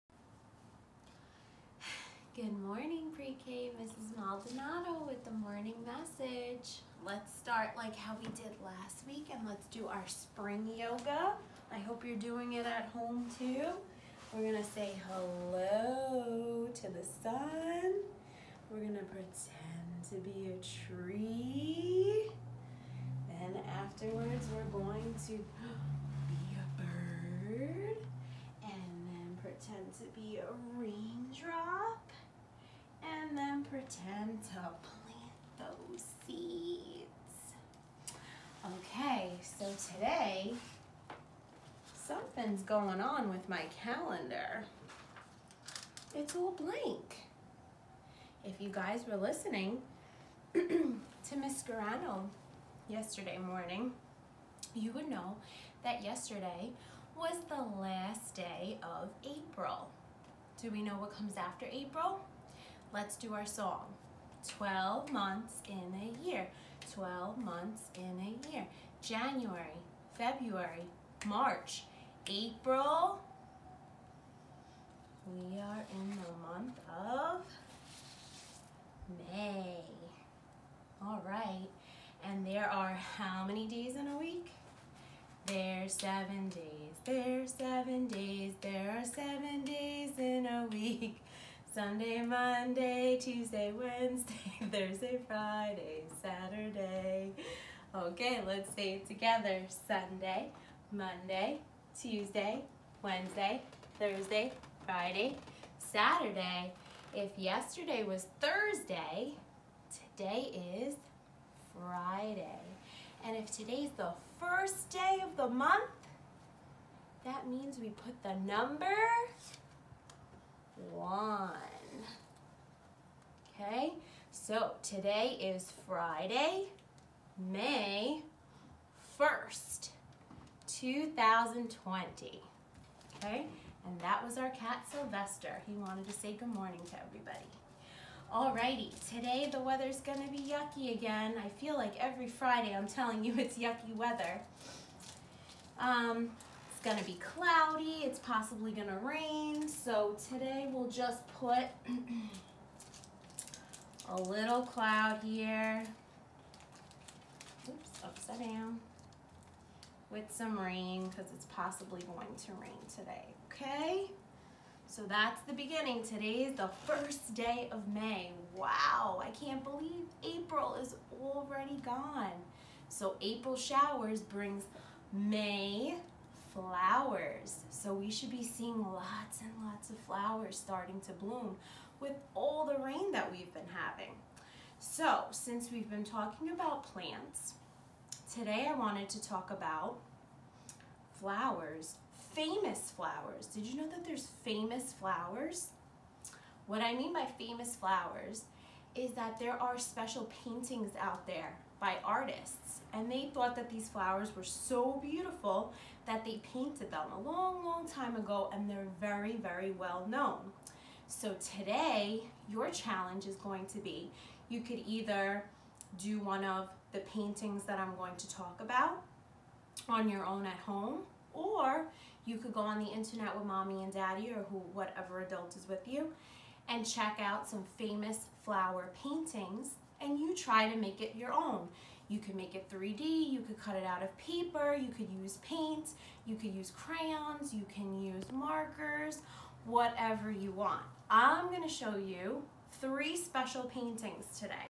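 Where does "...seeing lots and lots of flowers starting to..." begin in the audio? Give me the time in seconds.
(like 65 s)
178 s.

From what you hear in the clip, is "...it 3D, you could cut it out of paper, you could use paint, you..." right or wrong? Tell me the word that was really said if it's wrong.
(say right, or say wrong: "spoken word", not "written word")
right.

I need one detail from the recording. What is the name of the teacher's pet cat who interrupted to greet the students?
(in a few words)
Sylvester.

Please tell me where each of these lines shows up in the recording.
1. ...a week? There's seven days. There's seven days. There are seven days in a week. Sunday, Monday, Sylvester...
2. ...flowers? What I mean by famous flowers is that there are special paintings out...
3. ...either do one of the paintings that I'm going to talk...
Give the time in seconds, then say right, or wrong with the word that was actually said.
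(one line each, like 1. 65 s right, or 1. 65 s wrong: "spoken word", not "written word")
1. 84 s wrong: "Tuesday", not "Sylvester"
2. 194 s right
3. 214 s right.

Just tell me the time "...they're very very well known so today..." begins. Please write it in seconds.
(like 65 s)
208 s.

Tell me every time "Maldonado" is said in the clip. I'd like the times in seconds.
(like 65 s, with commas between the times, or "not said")
4 s.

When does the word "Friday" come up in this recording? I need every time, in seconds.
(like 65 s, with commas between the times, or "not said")
95 s, 104 s, 111 s, 125 s, 142 s.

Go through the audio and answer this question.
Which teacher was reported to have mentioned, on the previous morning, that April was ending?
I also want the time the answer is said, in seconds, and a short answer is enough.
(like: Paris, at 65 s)
Miss Garano, at 51 s.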